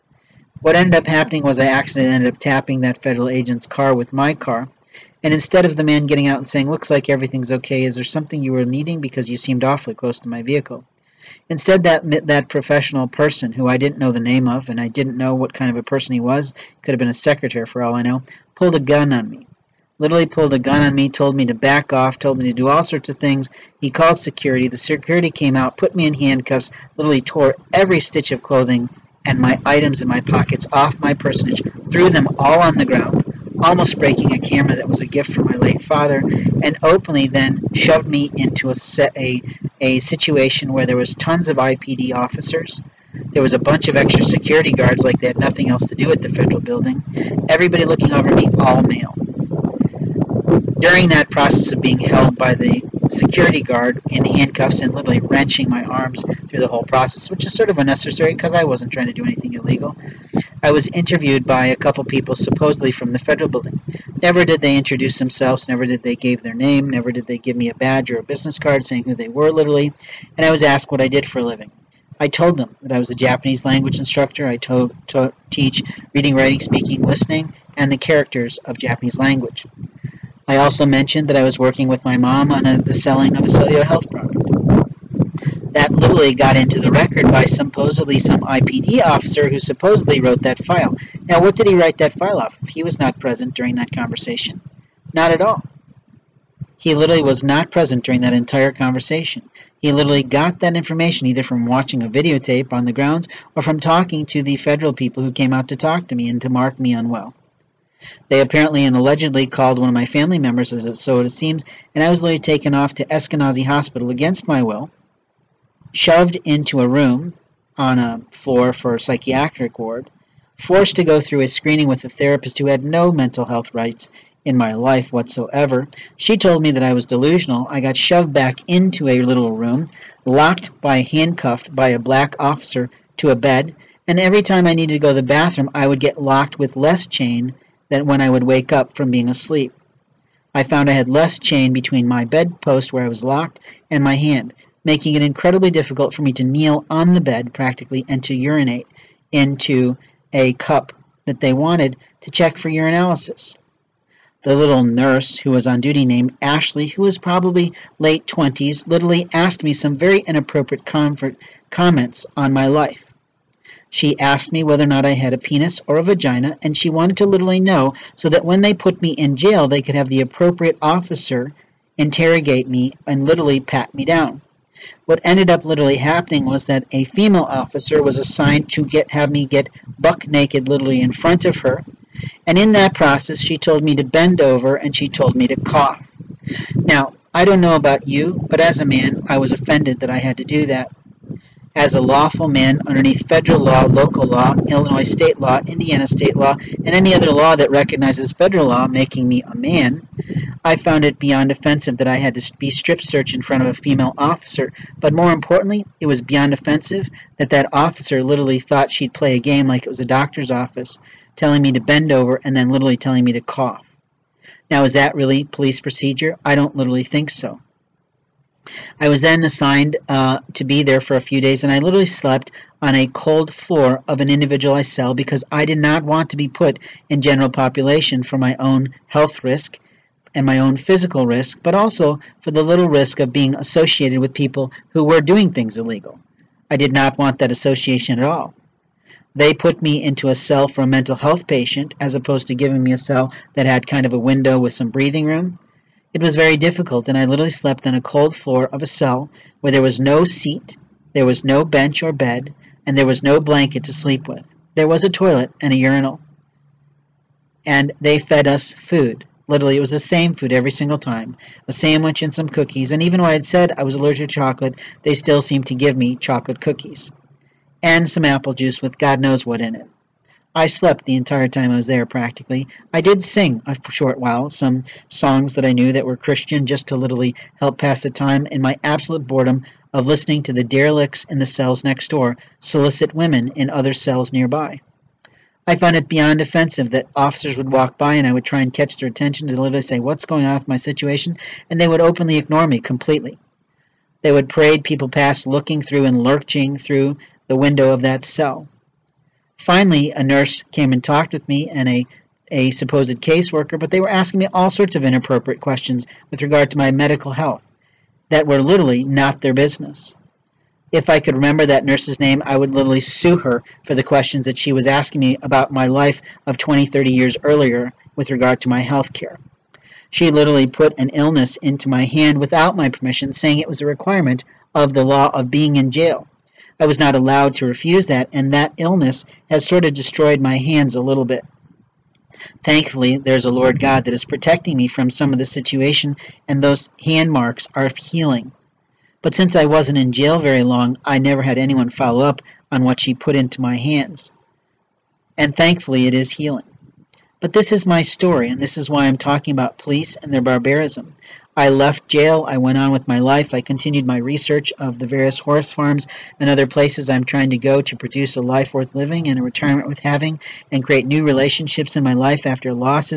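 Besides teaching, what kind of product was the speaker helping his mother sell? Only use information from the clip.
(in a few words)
cellular health product.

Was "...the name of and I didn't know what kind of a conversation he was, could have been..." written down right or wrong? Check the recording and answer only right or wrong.
wrong.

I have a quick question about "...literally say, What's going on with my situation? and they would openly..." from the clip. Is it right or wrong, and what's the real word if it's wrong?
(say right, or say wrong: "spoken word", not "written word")
right.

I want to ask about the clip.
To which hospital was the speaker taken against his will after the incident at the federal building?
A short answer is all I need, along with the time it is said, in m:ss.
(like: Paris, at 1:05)
Eskenazi Hospital, at 1:53.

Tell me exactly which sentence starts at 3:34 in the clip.
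Now, is that really police procedure?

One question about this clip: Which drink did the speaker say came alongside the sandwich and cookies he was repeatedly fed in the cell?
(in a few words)
apple juice.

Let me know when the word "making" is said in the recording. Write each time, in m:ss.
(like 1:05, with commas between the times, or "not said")
2:24, 3:18.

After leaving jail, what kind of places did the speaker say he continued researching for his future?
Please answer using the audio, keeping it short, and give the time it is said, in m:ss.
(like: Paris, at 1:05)
horse farms, at 5:55.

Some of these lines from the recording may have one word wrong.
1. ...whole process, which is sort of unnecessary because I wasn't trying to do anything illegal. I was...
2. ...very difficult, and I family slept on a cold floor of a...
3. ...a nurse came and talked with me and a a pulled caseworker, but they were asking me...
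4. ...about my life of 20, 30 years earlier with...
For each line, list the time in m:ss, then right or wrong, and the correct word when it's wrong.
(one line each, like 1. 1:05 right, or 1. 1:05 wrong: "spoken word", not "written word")
1. 0:56 right
2. 4:06 wrong: "literally", not "family"
3. 5:00 wrong: "supposed", not "pulled"
4. 5:15 right.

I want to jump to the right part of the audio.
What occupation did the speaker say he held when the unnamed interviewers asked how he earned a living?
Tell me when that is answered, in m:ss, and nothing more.
1:13.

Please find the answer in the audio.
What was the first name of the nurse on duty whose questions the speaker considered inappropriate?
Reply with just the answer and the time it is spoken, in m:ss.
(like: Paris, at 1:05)
Ashley, at 2:36.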